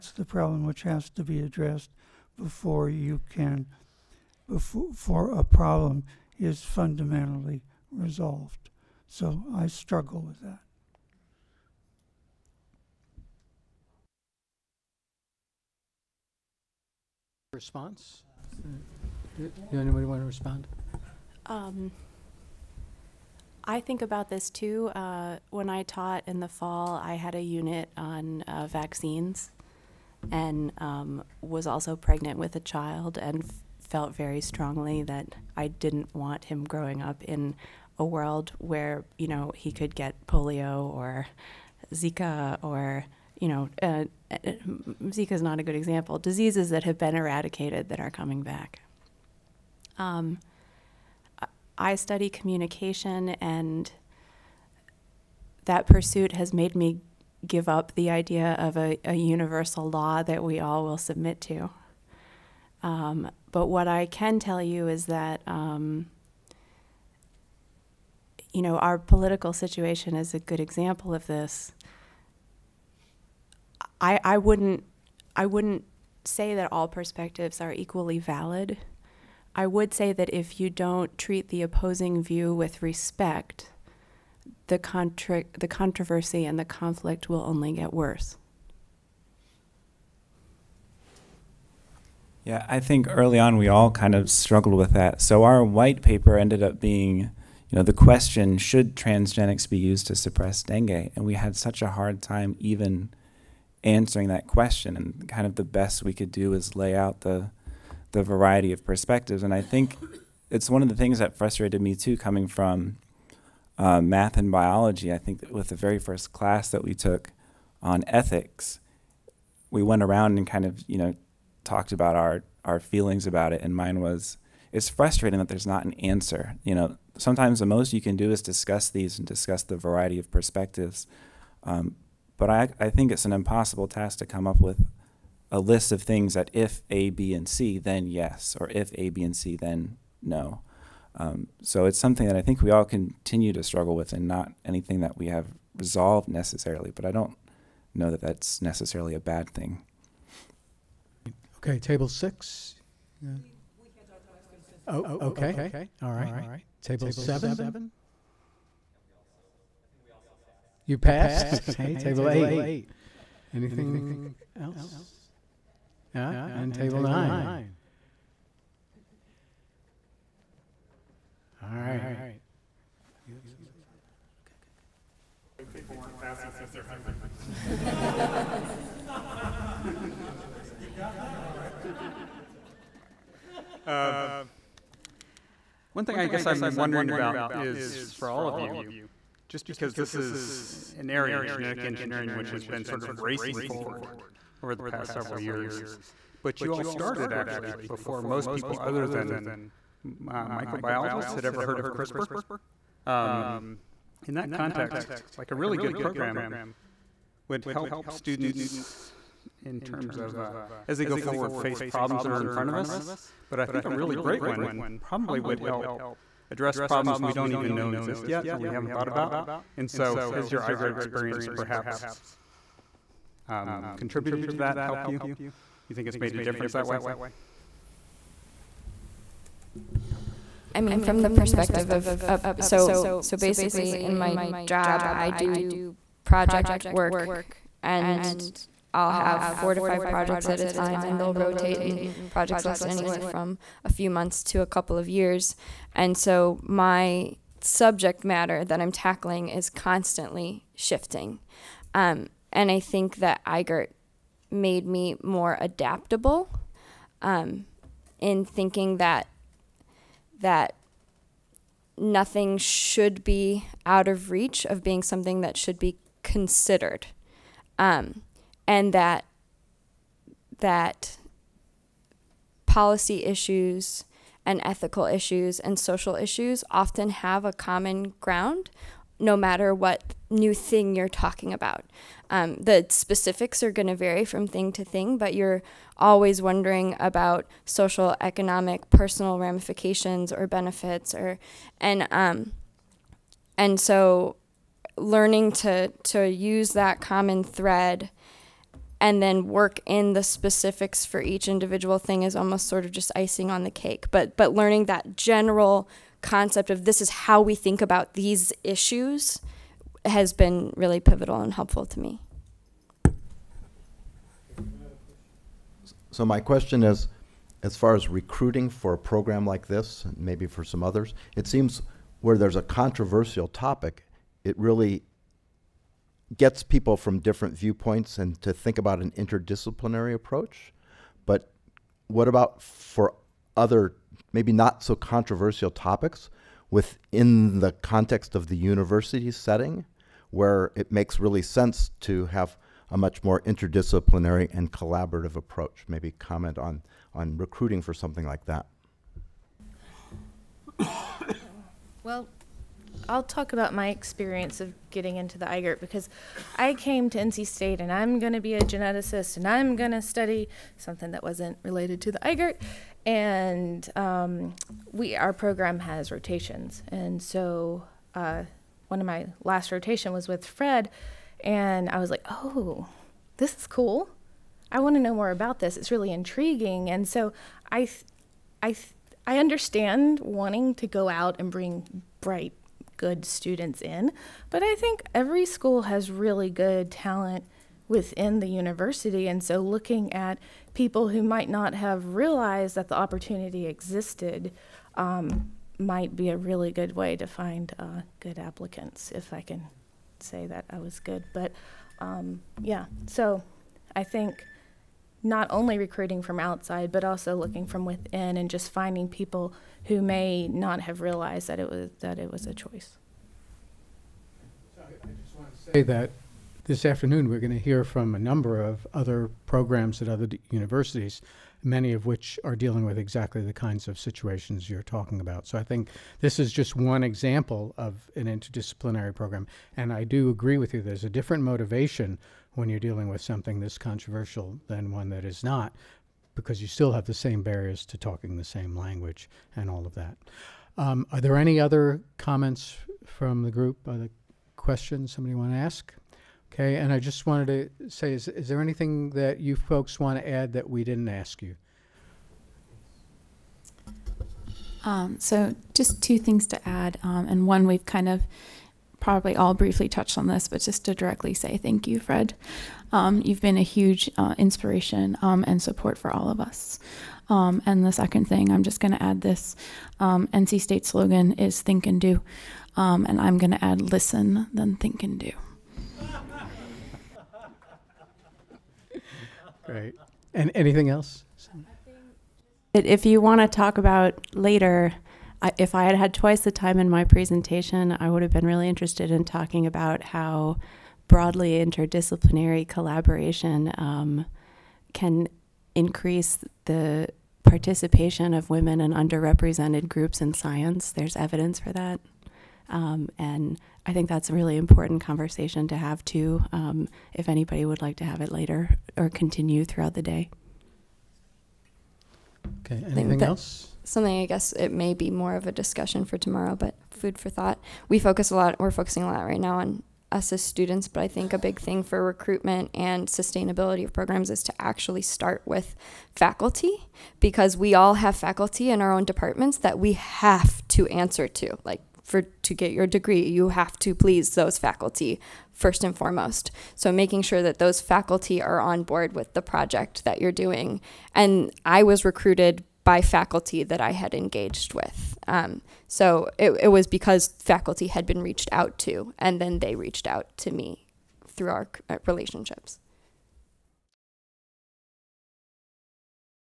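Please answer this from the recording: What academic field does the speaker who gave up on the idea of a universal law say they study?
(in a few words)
communication.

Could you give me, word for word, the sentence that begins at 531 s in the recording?
Like for to get your degree, you have to please those faculty first and foremost.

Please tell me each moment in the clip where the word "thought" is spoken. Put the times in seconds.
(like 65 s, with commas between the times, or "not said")
218 s, 517 s.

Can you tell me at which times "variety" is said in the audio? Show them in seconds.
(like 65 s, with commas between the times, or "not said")
108 s, 129 s.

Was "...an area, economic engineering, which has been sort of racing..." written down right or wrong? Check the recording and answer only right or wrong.
wrong.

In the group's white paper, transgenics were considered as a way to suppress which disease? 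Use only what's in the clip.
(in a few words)
dengue.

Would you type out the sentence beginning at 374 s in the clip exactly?
I want to know more about this.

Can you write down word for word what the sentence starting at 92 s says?
Yeah, I think early on we all kind of struggled with that.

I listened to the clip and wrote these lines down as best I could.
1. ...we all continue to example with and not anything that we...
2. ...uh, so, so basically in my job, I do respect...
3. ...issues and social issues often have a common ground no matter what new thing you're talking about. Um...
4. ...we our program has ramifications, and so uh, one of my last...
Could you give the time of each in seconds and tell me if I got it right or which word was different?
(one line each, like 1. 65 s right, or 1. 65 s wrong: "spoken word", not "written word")
1. 142 s wrong: "struggle", not "example"
2. 232 s wrong: "project", not "respect"
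3. 275 s right
4. 364 s wrong: "rotations", not "ramifications".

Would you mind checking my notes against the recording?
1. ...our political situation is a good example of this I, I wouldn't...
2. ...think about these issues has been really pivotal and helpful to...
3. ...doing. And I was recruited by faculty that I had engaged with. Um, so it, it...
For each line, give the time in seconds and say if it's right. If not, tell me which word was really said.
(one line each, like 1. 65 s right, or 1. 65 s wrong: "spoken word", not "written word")
1. 68 s right
2. 307 s right
3. 540 s right.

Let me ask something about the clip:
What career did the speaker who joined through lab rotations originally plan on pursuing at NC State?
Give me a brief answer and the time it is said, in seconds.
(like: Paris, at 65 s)
geneticist, at 358 s.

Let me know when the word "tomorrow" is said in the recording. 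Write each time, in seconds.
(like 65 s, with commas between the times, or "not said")
516 s.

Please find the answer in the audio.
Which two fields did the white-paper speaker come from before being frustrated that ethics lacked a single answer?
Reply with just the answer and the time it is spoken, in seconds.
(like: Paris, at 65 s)
math and biology, at 114 s.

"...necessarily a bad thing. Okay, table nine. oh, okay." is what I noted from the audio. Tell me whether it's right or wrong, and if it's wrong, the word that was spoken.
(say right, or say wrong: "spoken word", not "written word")
wrong: "six", not "nine".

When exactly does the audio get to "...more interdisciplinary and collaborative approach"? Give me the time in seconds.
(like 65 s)
343 s.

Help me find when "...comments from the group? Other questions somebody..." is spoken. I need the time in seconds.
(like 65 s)
442 s.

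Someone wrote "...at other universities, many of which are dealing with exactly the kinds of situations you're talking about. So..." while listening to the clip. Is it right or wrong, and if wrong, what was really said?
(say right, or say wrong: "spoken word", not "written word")
right.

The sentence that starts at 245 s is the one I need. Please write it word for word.
And so my subject matter that I'm tackling is constantly shifting.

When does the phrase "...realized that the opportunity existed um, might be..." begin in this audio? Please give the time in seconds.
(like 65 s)
392 s.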